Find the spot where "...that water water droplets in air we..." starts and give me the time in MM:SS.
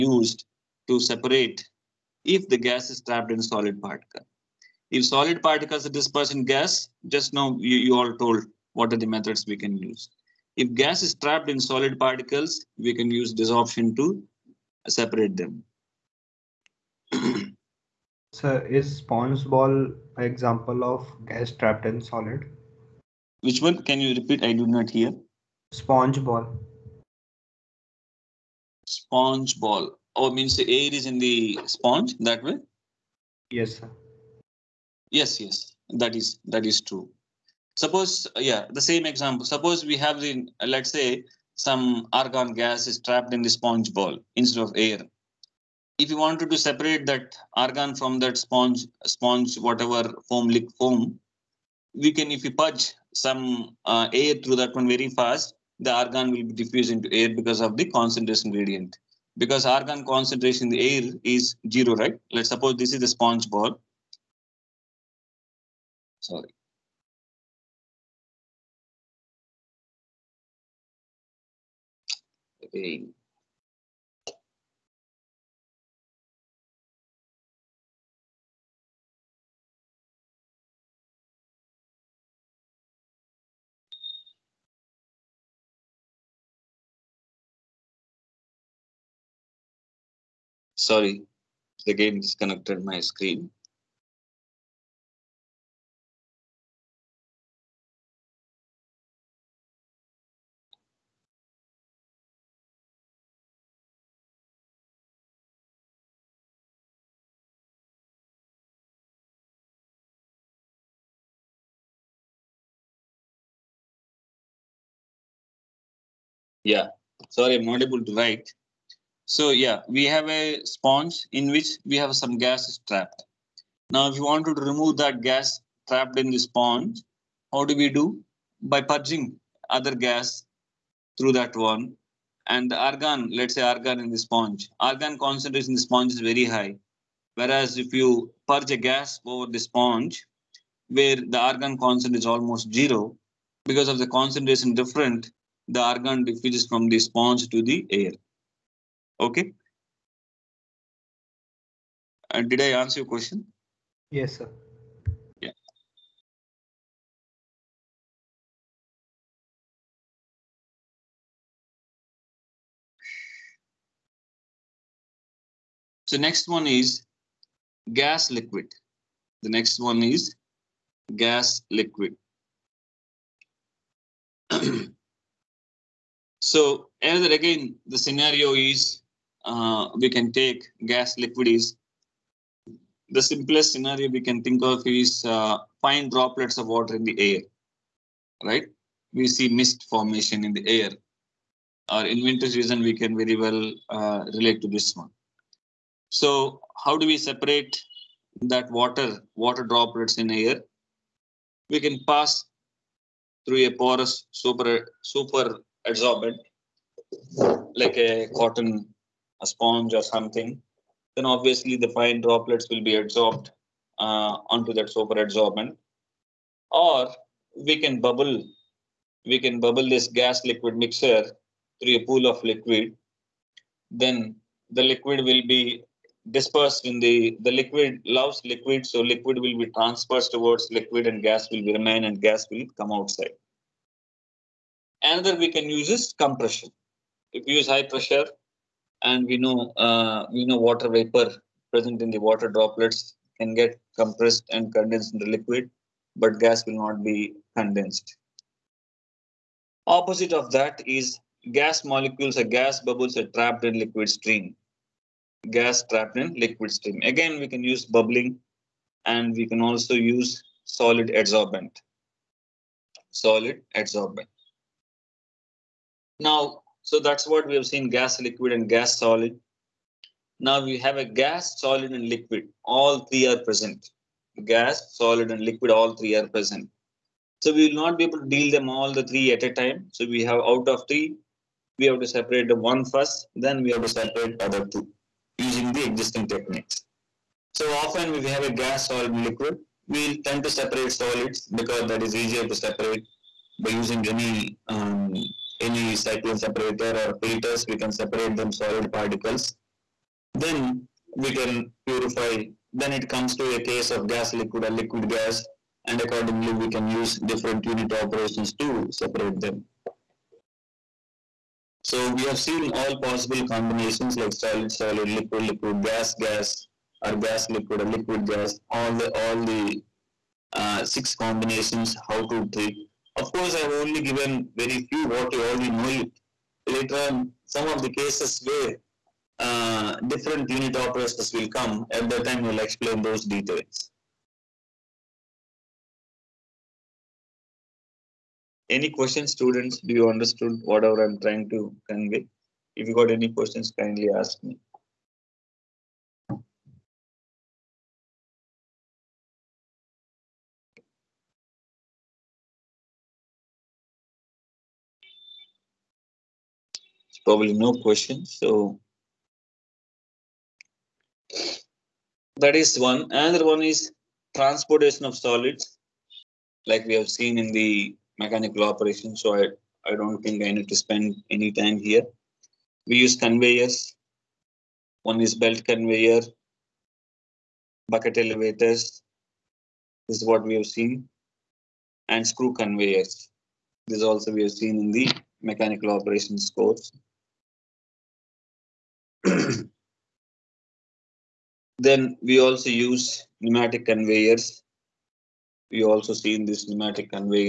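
03:18.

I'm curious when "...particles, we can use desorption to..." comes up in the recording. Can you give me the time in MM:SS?
00:11.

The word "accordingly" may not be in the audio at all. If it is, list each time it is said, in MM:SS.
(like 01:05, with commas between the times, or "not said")
05:05.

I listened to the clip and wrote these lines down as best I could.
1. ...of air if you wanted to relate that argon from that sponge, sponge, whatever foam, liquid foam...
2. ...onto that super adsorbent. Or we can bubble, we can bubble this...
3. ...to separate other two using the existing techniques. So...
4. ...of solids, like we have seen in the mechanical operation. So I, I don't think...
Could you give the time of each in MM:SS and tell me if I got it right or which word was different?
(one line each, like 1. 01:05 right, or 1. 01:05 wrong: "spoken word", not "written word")
1. 00:44 wrong: "separate", not "relate"
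2. 03:34 right
3. 04:43 right
4. 06:05 right.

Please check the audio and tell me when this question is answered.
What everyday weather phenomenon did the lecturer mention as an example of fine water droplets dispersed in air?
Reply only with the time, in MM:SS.
03:09.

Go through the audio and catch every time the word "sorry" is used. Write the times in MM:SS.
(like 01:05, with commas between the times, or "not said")
01:06, 01:30, 01:57.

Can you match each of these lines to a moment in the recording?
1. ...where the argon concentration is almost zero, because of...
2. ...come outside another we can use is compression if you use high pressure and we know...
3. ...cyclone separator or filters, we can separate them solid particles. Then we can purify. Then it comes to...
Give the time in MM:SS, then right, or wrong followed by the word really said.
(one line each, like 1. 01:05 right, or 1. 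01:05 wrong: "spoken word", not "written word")
1. 02:20 right
2. 03:52 right
3. 04:55 right.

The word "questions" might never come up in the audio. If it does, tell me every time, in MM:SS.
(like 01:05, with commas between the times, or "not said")
02:33, 05:38, 05:43, 05:57.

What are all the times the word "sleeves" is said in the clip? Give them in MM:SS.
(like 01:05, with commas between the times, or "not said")
not said.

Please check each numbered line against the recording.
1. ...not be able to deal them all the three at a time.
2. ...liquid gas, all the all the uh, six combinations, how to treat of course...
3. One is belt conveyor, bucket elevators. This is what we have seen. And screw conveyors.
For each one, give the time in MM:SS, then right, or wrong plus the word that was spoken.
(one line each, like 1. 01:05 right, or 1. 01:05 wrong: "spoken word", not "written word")
1. 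04:37 right
2. 05:17 right
3. 06:15 right.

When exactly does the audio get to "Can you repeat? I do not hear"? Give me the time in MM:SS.
00:23.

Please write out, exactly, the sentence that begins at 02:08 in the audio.
By purging other gas through that one.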